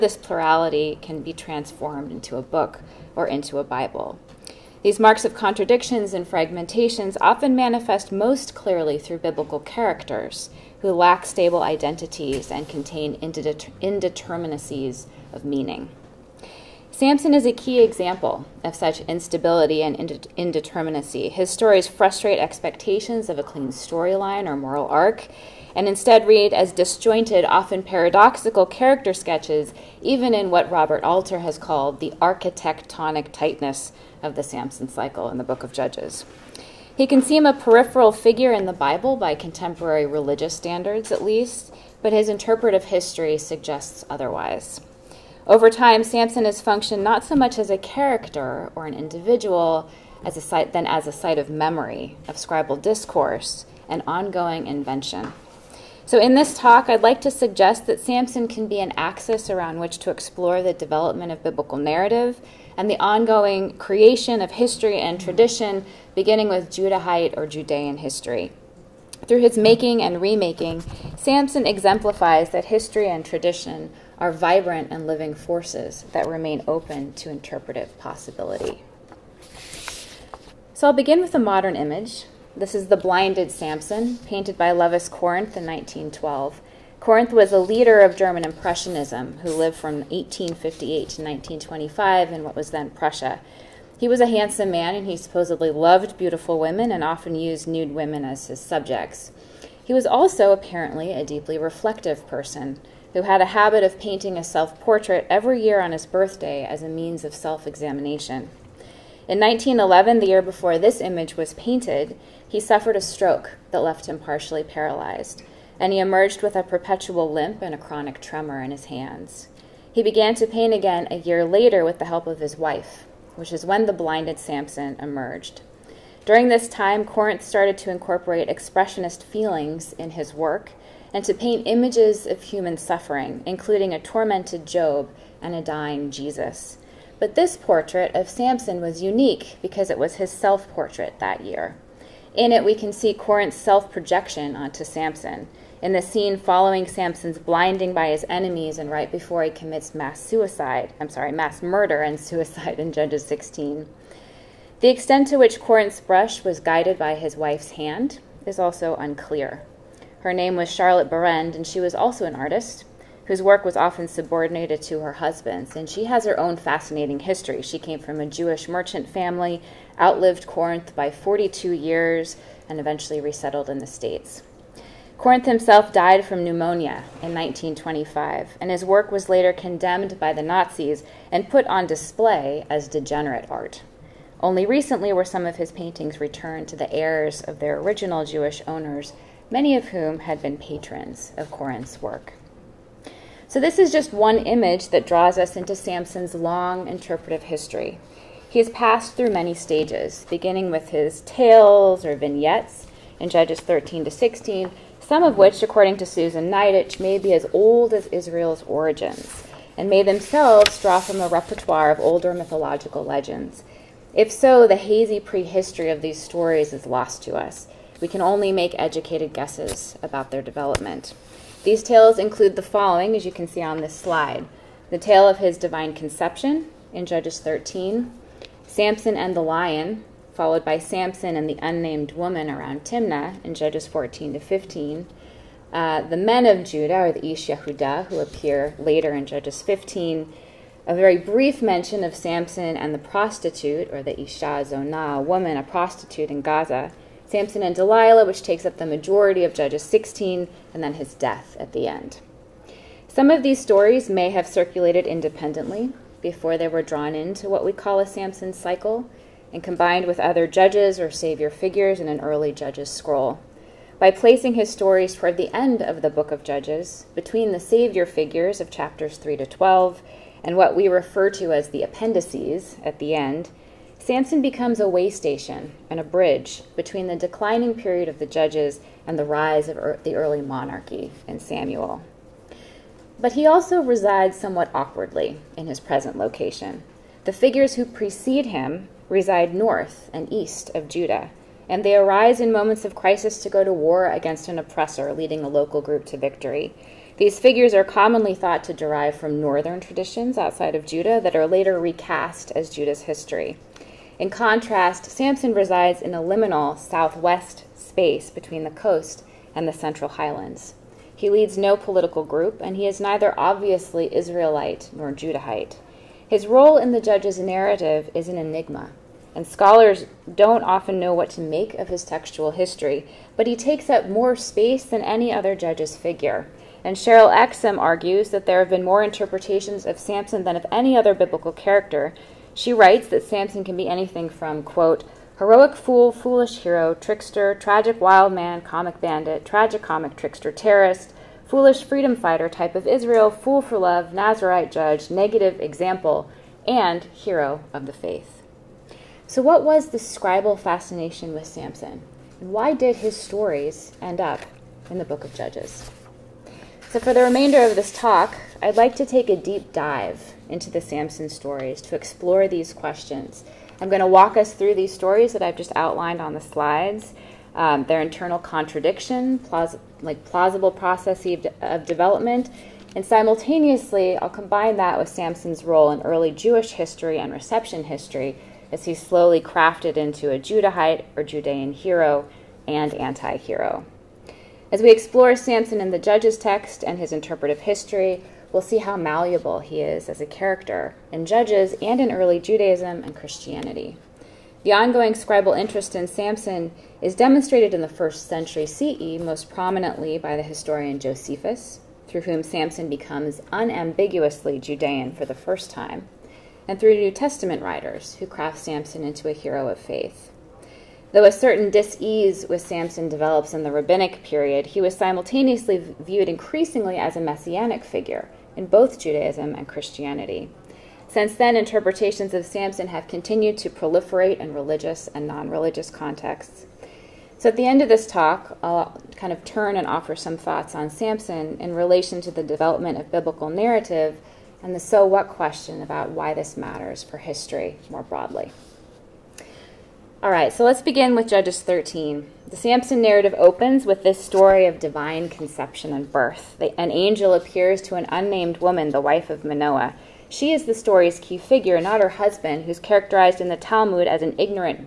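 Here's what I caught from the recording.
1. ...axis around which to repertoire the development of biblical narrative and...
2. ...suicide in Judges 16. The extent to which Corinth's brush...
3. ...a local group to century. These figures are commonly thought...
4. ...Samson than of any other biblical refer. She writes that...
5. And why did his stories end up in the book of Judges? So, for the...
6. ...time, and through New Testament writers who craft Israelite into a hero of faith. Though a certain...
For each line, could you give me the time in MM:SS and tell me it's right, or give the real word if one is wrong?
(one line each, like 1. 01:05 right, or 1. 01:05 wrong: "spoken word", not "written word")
1. 00:58 wrong: "explore", not "repertoire"
2. 02:32 right
3. 04:55 wrong: "victory", not "century"
4. 05:29 wrong: "character", not "refer"
5. 05:52 right
6. 06:45 wrong: "Samson", not "Israelite".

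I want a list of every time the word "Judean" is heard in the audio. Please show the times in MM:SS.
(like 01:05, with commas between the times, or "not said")
01:07, 06:21, 06:44.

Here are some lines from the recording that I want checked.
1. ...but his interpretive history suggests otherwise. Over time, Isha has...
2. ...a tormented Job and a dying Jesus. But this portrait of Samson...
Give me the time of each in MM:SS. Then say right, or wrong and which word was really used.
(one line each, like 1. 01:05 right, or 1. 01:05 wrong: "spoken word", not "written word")
1. 00:42 wrong: "Samson", not "Isha"
2. 02:13 right.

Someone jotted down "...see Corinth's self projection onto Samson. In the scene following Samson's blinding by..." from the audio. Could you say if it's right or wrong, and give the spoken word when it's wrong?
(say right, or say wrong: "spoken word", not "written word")
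right.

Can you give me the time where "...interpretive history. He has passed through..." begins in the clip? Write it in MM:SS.
03:16.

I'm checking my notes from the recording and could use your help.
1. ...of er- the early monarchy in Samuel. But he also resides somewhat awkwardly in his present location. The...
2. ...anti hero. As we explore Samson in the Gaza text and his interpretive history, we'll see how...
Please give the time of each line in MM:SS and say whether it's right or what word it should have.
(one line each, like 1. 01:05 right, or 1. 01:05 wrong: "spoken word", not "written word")
1. 04:39 right
2. 06:22 wrong: "Judges", not "Gaza".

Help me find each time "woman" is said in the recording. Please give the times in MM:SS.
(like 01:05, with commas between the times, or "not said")
03:52, 04:05, 07:28.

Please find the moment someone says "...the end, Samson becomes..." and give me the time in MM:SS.
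04:32.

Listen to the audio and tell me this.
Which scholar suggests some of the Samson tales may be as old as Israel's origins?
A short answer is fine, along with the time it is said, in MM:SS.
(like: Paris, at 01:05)
Susan Niditch, at 03:26.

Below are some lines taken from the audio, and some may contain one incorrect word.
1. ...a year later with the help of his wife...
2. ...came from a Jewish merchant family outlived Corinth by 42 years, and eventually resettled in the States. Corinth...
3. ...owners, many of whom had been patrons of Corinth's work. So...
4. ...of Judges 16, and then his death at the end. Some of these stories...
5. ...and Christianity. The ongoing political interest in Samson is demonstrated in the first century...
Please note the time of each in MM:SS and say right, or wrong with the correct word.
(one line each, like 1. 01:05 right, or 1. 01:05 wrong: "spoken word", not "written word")
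1. 02:01 right
2. 02:47 right
3. 03:08 right
4. 04:09 right
5. 06:33 wrong: "scribal", not "political".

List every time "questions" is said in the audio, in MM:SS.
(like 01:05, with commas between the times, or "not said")
06:02, 07:15.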